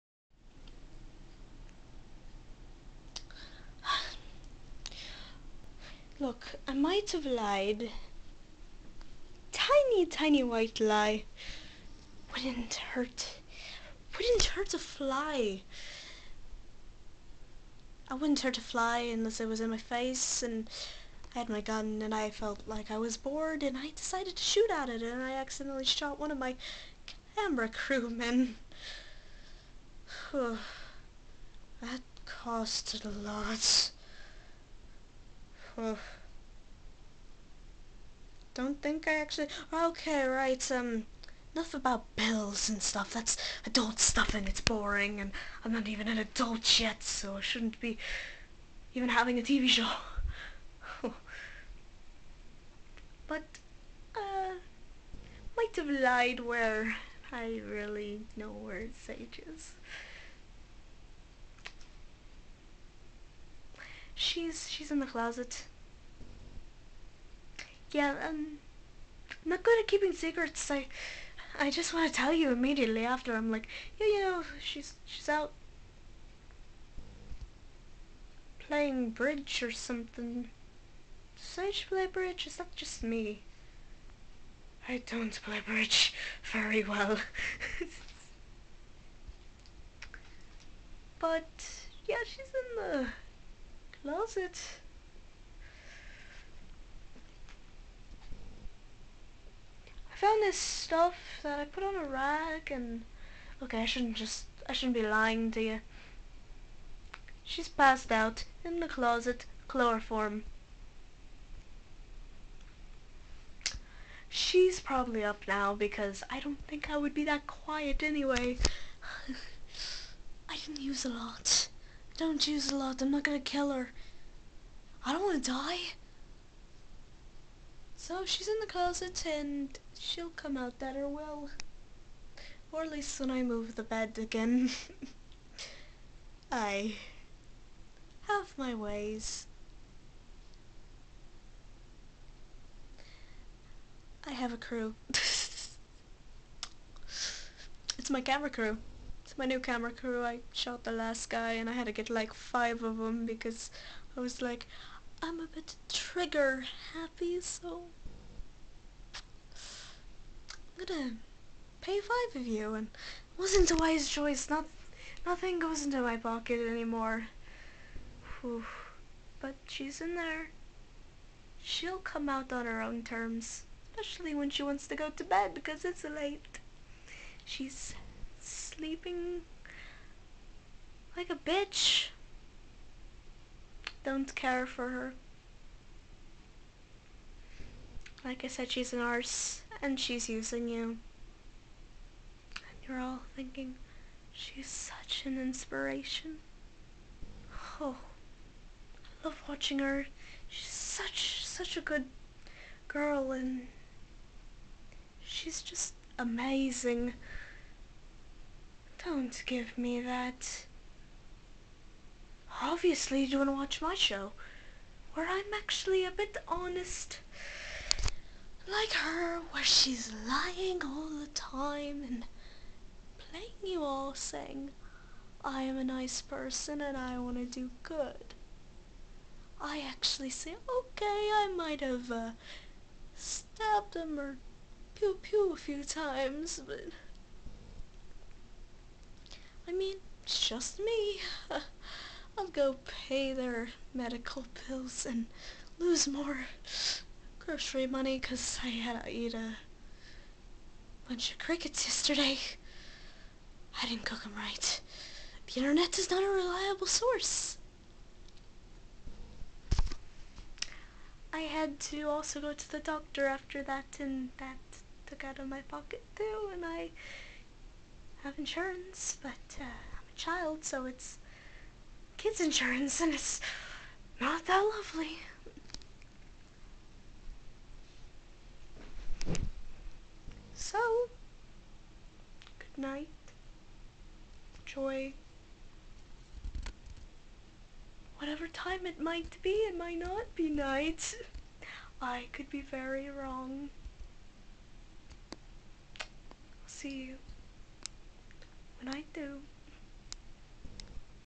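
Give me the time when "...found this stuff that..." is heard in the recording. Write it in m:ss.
1:40.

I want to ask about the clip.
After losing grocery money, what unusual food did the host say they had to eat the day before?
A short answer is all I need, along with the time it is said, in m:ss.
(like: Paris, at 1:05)
Crickets, at 4:11.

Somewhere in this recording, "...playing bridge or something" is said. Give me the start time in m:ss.
1:18.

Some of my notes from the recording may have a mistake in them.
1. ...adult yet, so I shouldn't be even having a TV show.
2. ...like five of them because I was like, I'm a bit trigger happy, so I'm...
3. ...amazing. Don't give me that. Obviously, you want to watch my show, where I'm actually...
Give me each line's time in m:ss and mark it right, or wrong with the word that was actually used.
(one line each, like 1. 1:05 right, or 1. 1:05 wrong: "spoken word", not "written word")
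1. 0:46 right
2. 2:32 right
3. 3:26 right.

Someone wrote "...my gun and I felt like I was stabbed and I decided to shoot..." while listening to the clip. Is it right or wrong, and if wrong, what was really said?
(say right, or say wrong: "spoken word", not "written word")
wrong: "bored", not "stabbed".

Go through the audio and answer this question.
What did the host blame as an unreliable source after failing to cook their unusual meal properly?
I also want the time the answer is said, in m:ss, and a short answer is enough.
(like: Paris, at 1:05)
The internet, at 4:15.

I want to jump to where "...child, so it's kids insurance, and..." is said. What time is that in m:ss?
4:30.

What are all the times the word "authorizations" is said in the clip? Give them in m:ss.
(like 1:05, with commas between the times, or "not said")
not said.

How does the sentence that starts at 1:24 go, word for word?
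I don't play bridge very well.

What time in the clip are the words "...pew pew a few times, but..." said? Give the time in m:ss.
3:54.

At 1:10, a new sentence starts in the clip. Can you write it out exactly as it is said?
I I just want to tell you immediately after.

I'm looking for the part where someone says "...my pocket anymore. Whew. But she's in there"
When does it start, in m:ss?
2:46.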